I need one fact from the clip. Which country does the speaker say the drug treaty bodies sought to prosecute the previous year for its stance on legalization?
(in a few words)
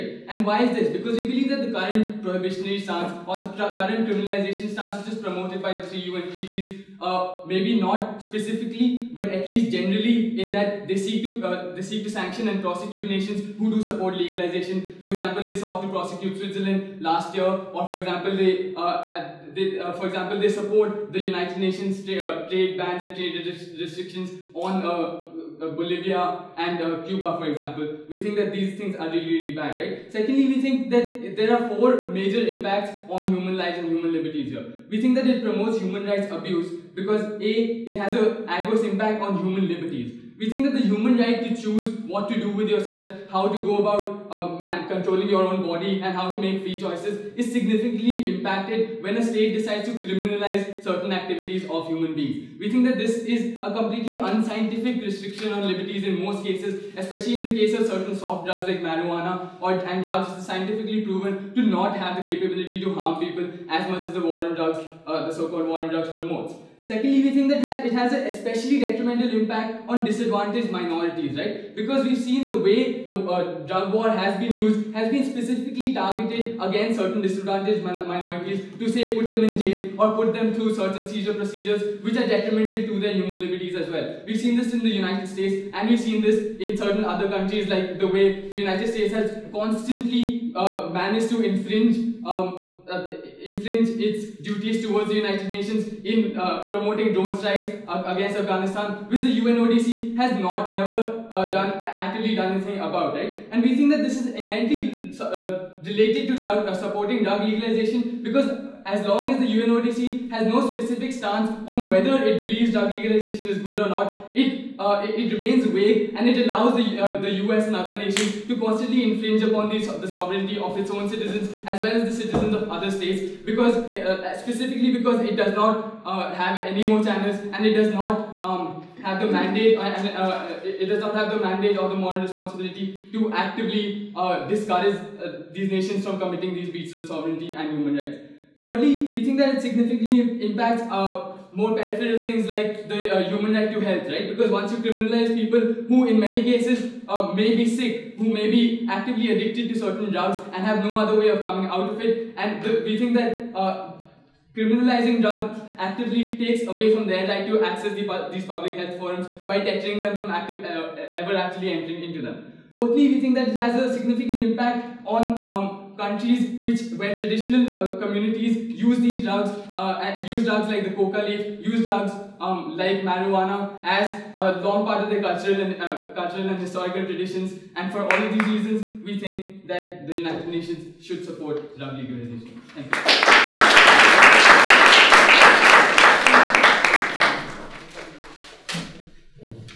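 Switzerland.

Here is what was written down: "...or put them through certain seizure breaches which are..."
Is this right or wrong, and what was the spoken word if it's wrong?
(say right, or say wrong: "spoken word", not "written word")
wrong: "procedures", not "breaches".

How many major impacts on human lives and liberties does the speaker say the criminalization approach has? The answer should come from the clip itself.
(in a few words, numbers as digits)
4.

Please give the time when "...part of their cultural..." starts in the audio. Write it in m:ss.
2:54.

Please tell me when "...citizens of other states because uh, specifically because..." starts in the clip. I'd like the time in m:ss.
2:02.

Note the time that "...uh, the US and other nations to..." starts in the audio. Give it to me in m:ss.
1:56.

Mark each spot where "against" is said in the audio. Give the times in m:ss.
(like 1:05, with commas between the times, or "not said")
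1:16, 1:37.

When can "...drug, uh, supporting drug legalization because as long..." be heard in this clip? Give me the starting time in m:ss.
1:46.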